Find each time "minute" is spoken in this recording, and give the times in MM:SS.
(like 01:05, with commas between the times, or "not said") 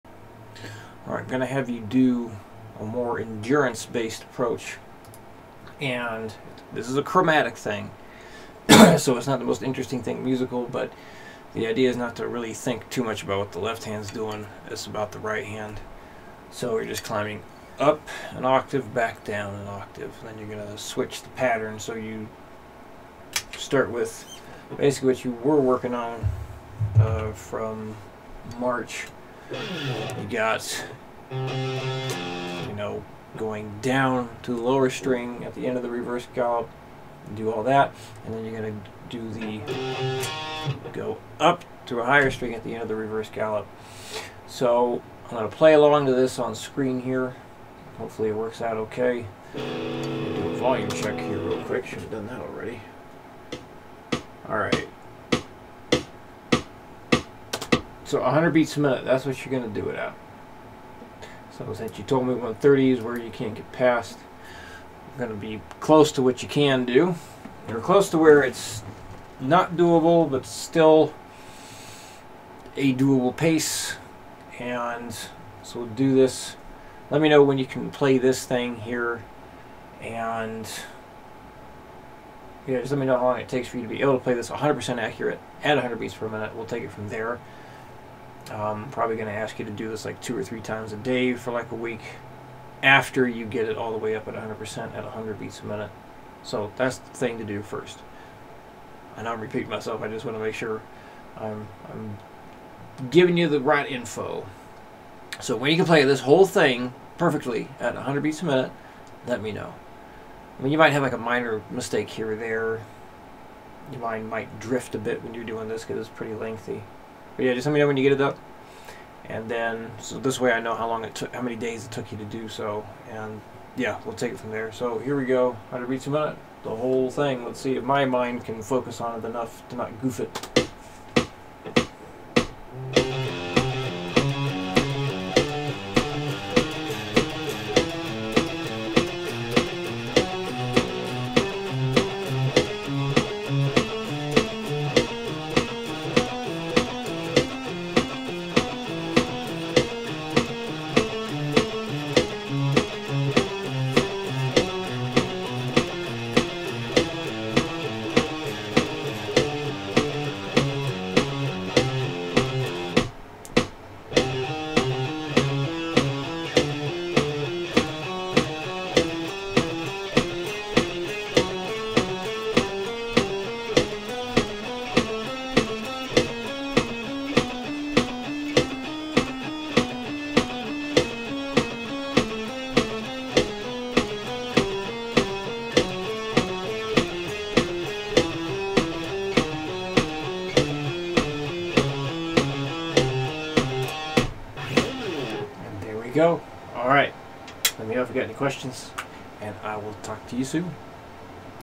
00:58, 01:26, 01:35, 01:48.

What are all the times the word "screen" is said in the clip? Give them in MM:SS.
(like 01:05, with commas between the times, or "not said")
00:46.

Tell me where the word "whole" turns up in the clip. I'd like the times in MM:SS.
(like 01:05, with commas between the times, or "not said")
01:46, 02:06.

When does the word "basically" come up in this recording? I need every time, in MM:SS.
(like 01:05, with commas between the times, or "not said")
00:24.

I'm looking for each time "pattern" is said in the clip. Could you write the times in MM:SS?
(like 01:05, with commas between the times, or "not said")
00:21.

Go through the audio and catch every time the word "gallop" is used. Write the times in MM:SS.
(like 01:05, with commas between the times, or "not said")
00:36, 00:43.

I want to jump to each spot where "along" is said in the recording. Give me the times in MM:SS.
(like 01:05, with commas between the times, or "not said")
00:45.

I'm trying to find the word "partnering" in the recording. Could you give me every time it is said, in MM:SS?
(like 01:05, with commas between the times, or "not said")
not said.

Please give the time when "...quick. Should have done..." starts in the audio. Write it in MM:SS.
00:51.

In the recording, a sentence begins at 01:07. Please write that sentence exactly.
You're close to where it's not doable, but still a doable pace.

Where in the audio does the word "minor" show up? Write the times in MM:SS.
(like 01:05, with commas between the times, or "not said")
01:51.